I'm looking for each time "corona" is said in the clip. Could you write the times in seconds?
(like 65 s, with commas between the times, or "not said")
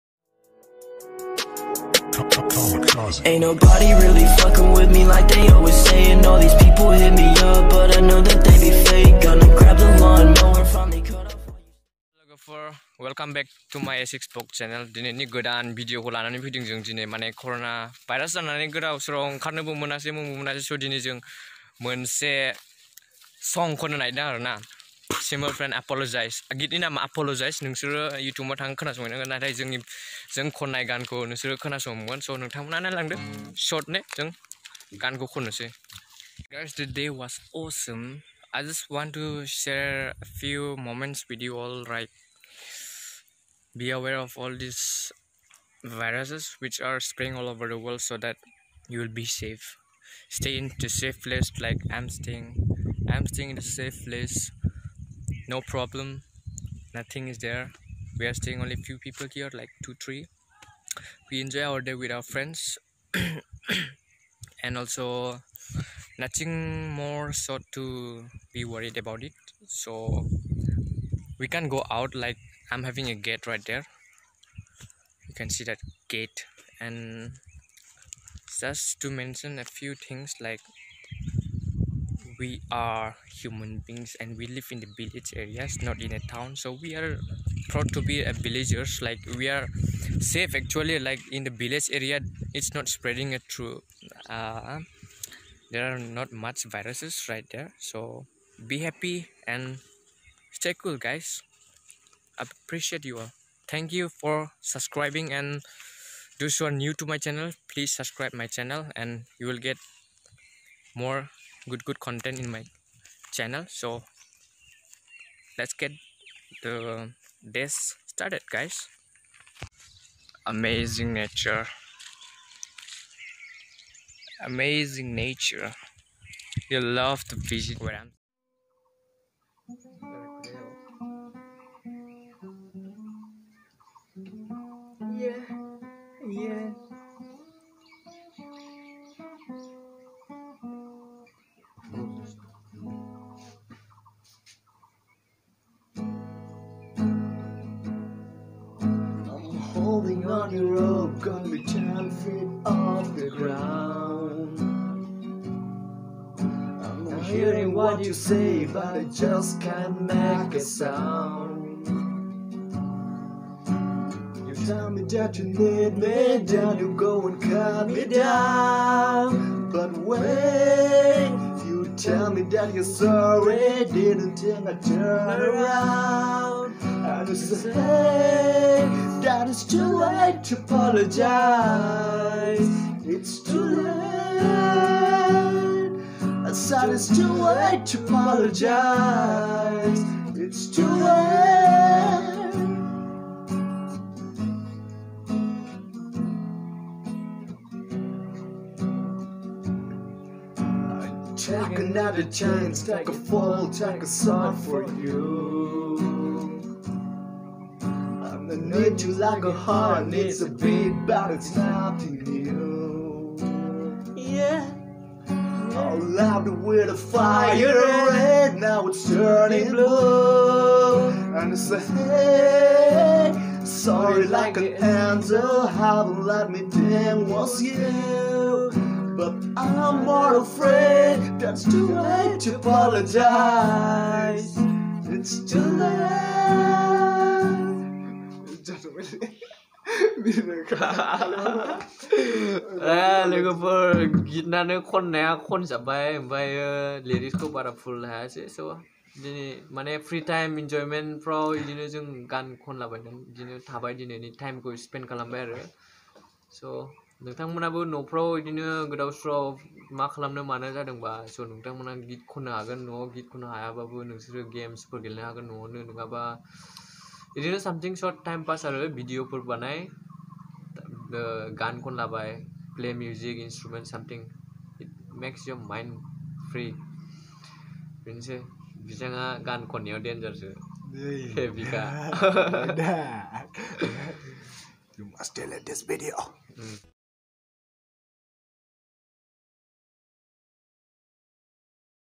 17 s.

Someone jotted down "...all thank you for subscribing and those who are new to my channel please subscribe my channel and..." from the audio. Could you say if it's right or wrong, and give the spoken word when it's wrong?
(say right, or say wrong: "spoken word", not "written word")
right.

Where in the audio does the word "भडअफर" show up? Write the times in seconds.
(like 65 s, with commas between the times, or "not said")
268 s.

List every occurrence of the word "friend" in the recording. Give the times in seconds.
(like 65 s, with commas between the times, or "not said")
25 s, 62 s.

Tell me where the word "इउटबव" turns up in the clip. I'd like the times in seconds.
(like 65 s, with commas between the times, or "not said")
28 s.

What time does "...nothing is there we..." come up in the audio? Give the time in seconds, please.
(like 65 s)
56 s.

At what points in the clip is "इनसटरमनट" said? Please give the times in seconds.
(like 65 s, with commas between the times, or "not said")
273 s.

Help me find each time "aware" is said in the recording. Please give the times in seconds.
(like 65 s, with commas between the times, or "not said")
43 s.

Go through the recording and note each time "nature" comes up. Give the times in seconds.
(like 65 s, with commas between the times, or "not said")
121 s, 125 s.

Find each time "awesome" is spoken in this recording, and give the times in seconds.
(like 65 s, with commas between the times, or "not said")
37 s.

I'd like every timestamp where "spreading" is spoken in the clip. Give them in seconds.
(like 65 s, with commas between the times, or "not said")
47 s, 92 s.